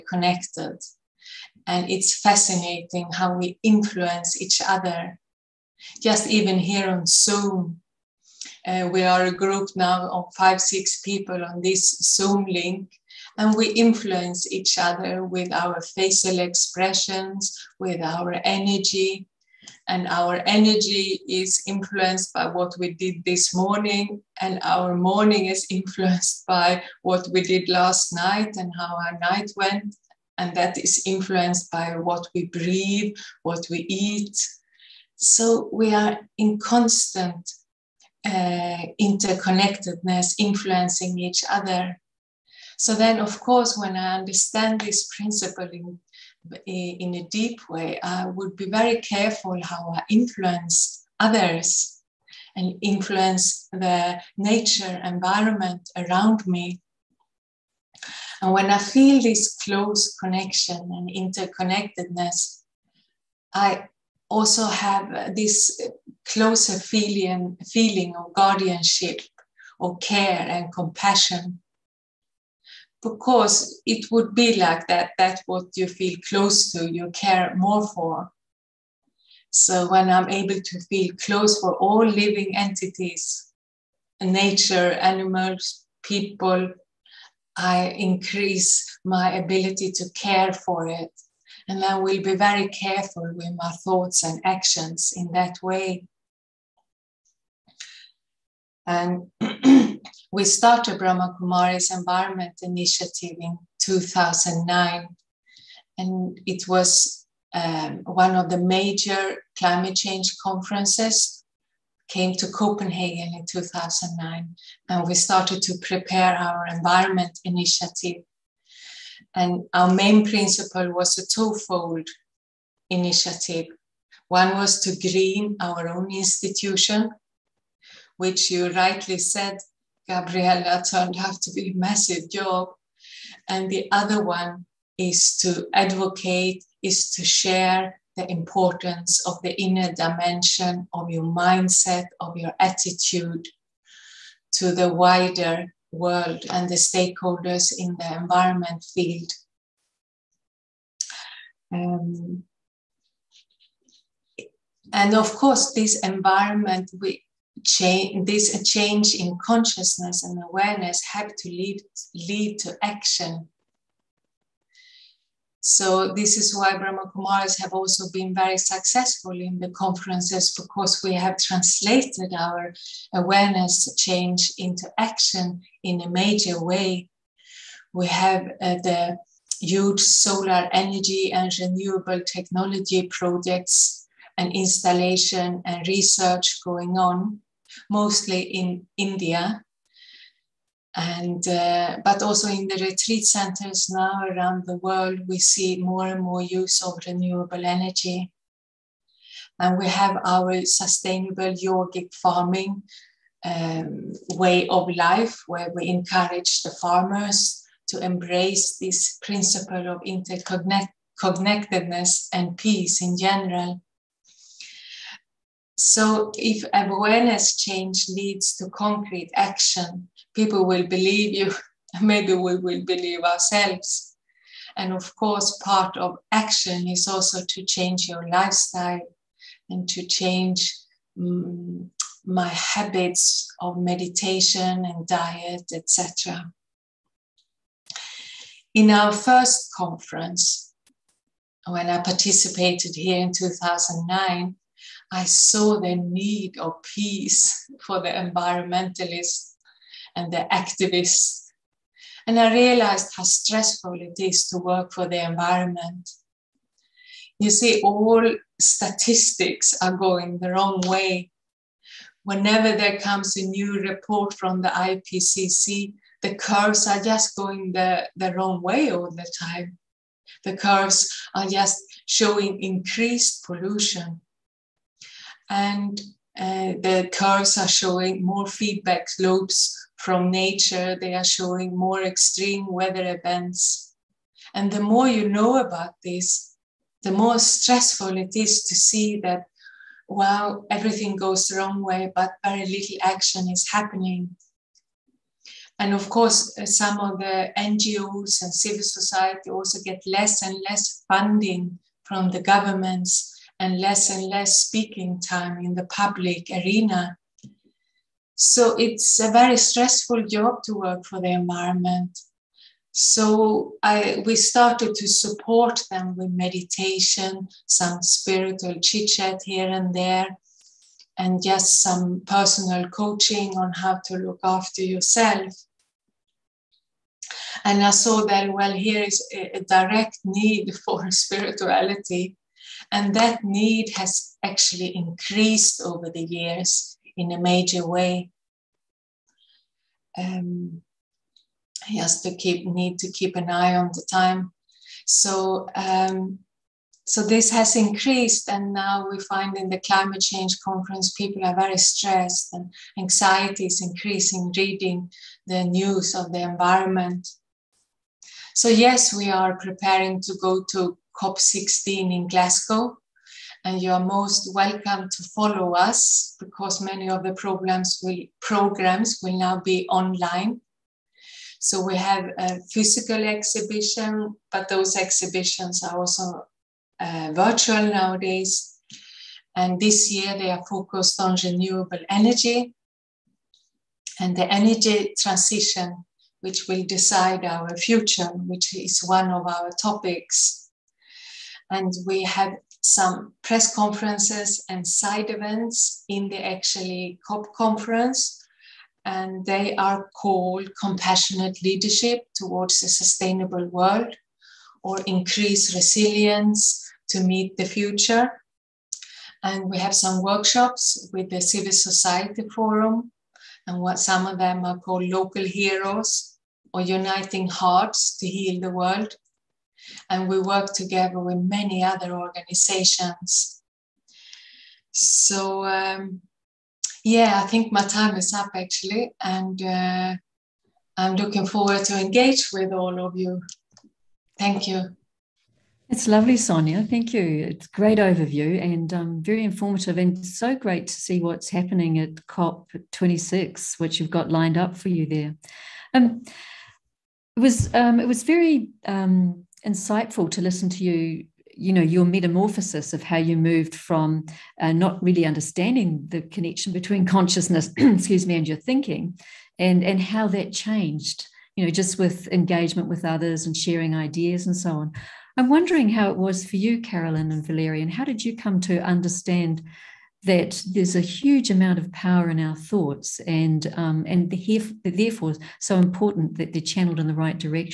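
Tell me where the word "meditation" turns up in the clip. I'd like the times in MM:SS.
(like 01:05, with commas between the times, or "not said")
03:53, 05:16.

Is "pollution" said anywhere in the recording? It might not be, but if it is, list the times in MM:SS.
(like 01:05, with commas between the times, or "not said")
04:33.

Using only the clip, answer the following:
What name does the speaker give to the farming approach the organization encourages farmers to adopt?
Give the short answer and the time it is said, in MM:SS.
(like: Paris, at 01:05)
sustainable yogic farming, at 03:20.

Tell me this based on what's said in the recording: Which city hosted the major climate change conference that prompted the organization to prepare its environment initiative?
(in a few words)
Copenhagen.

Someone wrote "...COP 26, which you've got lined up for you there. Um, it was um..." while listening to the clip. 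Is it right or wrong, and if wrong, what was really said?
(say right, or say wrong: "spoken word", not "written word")
right.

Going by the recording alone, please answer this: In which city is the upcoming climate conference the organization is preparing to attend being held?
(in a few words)
Glasgow.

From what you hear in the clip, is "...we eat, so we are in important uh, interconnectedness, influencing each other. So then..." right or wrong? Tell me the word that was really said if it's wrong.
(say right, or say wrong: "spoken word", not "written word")
wrong: "constant", not "important".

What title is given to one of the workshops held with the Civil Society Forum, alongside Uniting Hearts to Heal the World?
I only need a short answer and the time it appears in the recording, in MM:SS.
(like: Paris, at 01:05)
Local Heroes, at 06:55.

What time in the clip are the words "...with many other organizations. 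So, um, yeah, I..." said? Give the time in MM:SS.
07:01.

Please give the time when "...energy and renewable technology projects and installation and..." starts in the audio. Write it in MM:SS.
03:00.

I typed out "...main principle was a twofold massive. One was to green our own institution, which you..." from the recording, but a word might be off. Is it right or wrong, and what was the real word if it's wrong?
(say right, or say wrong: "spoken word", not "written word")
wrong: "initiative", not "massive".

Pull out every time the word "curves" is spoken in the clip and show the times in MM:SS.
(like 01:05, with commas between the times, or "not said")
04:26, 04:30, 04:37.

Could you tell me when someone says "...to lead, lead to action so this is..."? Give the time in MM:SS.
02:41.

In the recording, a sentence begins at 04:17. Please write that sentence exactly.
You see, all statistics are going the wrong way.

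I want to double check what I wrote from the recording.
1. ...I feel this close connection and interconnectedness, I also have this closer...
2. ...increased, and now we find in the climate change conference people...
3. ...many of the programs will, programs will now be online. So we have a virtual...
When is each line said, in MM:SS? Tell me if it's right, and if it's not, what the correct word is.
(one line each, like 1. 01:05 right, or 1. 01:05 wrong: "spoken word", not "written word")
1. 00:58 right
2. 05:47 right
3. 06:06 wrong: "physical", not "virtual".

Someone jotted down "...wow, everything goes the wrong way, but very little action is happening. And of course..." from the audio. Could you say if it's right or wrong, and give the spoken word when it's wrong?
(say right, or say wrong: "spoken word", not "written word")
right.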